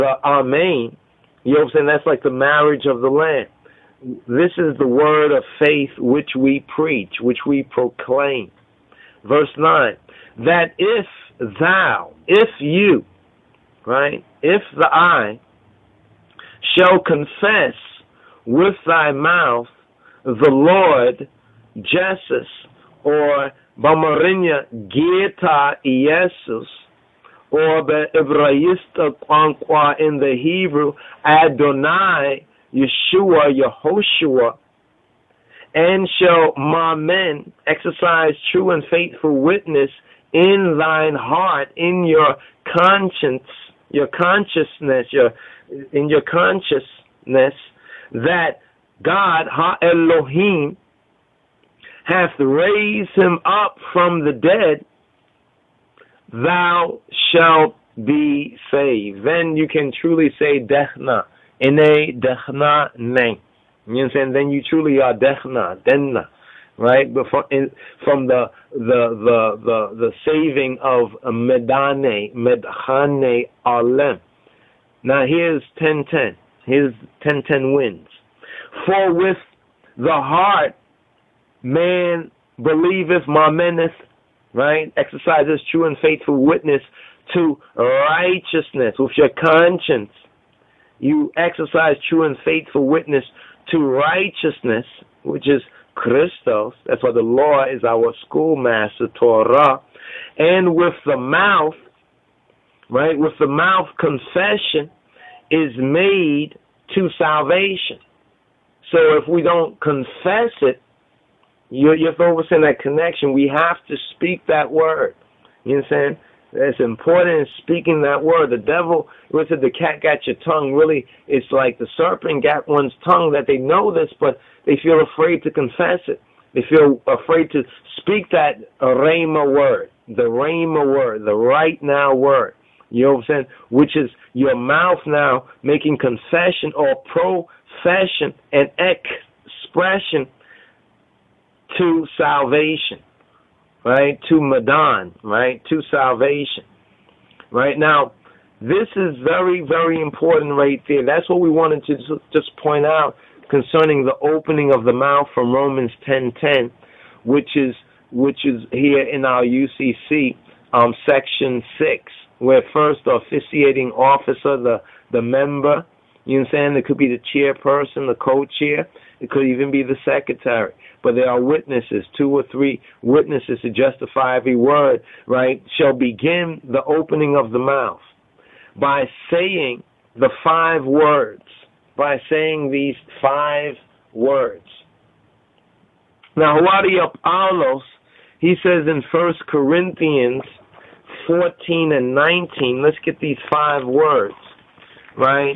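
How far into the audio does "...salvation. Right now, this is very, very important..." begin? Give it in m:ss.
2:25.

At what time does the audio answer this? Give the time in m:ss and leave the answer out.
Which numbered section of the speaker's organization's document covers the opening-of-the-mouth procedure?
2:41.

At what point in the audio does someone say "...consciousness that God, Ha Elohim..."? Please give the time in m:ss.
0:46.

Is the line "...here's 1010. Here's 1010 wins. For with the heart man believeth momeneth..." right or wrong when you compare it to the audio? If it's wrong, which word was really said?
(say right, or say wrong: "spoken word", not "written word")
right.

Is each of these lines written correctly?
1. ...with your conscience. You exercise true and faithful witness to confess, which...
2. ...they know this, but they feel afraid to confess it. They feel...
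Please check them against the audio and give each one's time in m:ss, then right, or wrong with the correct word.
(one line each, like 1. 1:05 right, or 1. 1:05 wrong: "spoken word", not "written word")
1. 1:28 wrong: "righteousness", not "confess"
2. 2:03 right.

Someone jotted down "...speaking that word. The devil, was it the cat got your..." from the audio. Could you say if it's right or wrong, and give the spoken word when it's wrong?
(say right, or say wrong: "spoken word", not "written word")
right.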